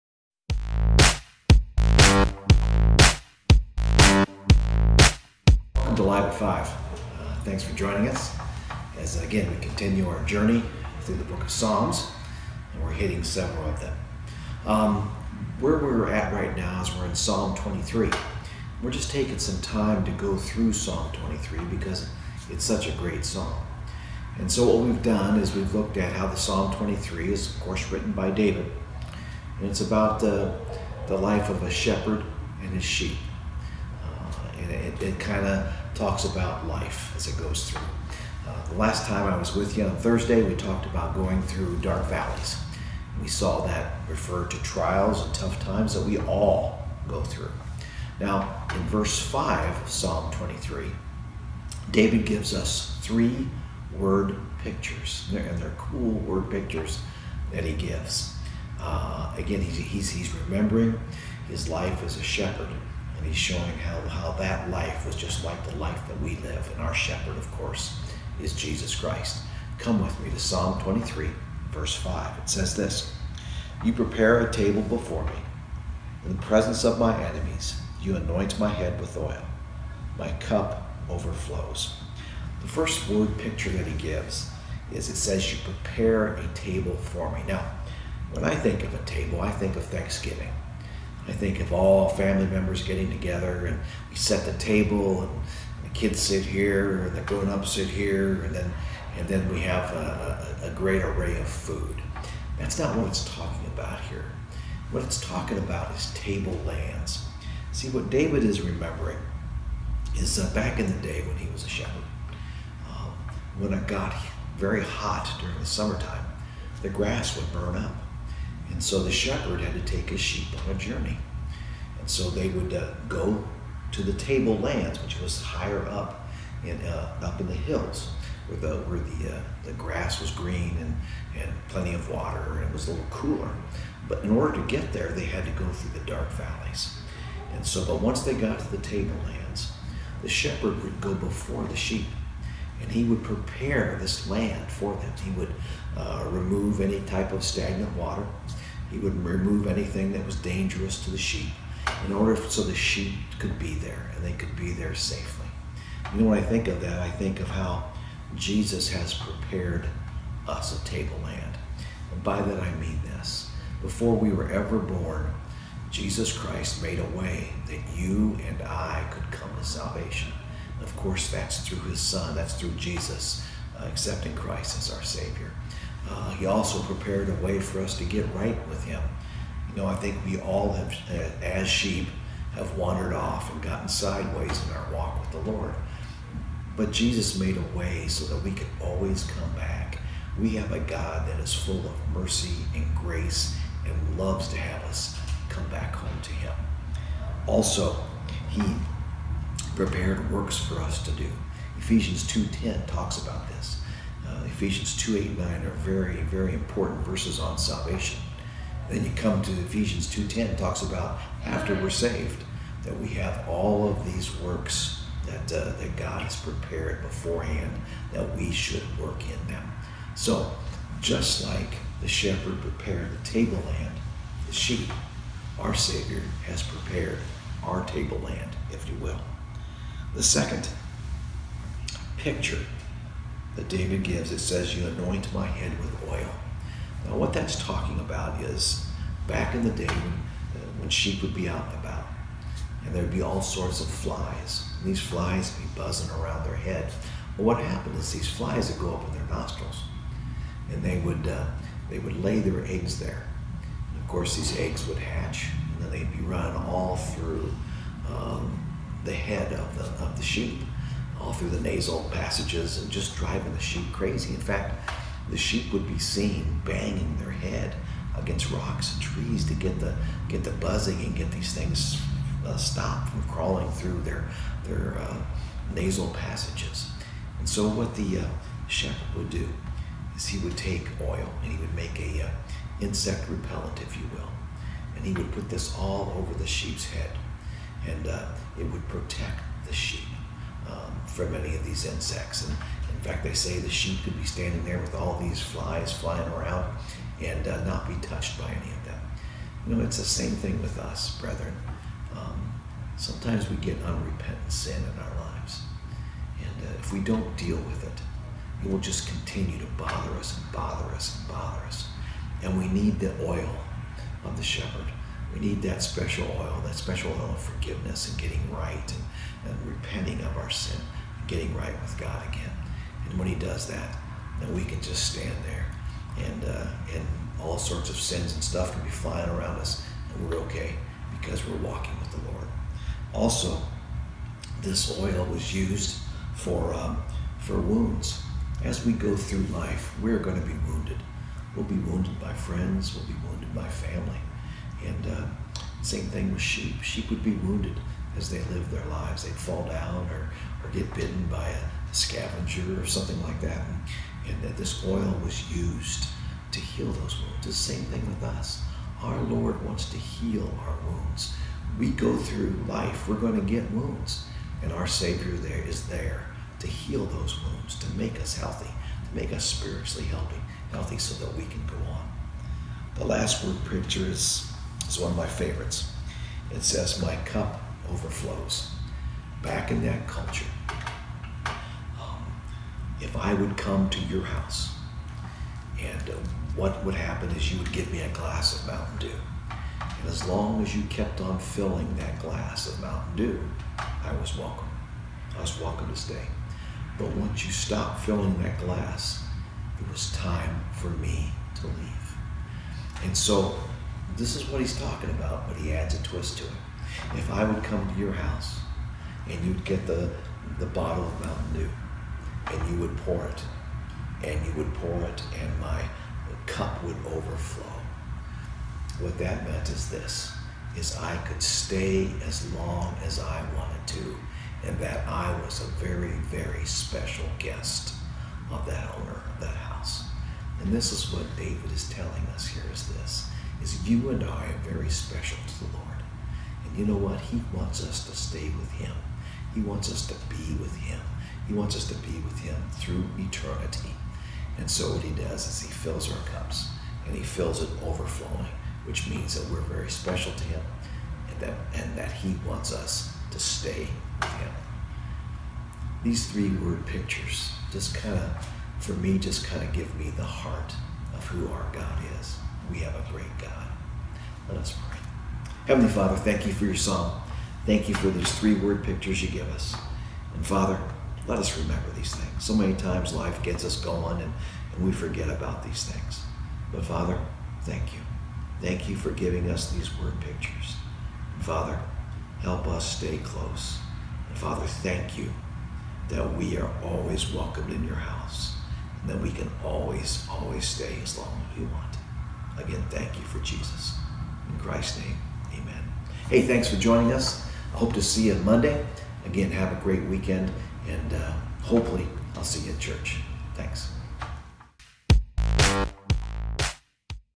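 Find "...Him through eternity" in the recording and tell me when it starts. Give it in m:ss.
7:22.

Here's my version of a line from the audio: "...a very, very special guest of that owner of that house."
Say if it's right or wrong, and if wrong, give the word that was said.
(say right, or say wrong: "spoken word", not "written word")
right.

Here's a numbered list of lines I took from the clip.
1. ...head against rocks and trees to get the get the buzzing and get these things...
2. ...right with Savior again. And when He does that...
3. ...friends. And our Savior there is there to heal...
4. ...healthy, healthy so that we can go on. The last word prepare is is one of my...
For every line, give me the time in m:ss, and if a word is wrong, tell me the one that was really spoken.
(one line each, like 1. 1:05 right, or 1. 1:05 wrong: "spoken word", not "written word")
1. 4:27 right
2. 5:21 wrong: "God", not "Savior"
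3. 6:03 wrong: "wounds", not "friends"
4. 6:10 wrong: "picture", not "prepare".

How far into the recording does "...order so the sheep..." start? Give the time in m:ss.
2:32.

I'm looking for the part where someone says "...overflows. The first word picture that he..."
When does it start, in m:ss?
1:21.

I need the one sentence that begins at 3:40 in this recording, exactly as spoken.
So just like the shepherd prepared the tableland, the sheep, our Savior has prepared our tableland, if you will.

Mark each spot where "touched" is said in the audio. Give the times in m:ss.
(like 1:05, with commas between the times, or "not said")
4:58.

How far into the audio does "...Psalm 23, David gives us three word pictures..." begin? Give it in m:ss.
0:49.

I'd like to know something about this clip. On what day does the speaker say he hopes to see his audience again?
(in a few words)
Monday.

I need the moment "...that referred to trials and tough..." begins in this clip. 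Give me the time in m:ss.
0:43.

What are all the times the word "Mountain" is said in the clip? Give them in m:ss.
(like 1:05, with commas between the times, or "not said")
6:28, 6:32, 6:51.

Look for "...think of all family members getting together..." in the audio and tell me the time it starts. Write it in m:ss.
1:31.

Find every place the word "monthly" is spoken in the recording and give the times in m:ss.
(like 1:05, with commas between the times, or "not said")
not said.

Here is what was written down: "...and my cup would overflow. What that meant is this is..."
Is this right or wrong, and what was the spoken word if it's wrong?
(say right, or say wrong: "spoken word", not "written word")
right.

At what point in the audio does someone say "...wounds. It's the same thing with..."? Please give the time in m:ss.
5:57.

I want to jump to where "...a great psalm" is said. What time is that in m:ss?
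0:22.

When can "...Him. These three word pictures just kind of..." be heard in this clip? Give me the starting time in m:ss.
7:34.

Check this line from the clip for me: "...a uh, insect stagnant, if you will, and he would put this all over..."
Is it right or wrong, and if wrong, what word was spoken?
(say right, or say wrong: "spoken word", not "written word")
wrong: "repellent", not "stagnant".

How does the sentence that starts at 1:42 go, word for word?
That's not what it's talking about here.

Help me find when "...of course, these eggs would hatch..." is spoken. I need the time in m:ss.
4:14.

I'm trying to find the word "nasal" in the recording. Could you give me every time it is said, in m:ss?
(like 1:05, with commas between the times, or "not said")
4:21, 4:35.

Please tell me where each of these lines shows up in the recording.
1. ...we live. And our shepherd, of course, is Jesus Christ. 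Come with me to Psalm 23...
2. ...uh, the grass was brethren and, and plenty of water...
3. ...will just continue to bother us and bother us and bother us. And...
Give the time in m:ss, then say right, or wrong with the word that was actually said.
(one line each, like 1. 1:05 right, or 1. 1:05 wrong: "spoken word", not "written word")
1. 1:06 right
2. 2:09 wrong: "green", not "brethren"
3. 5:08 right.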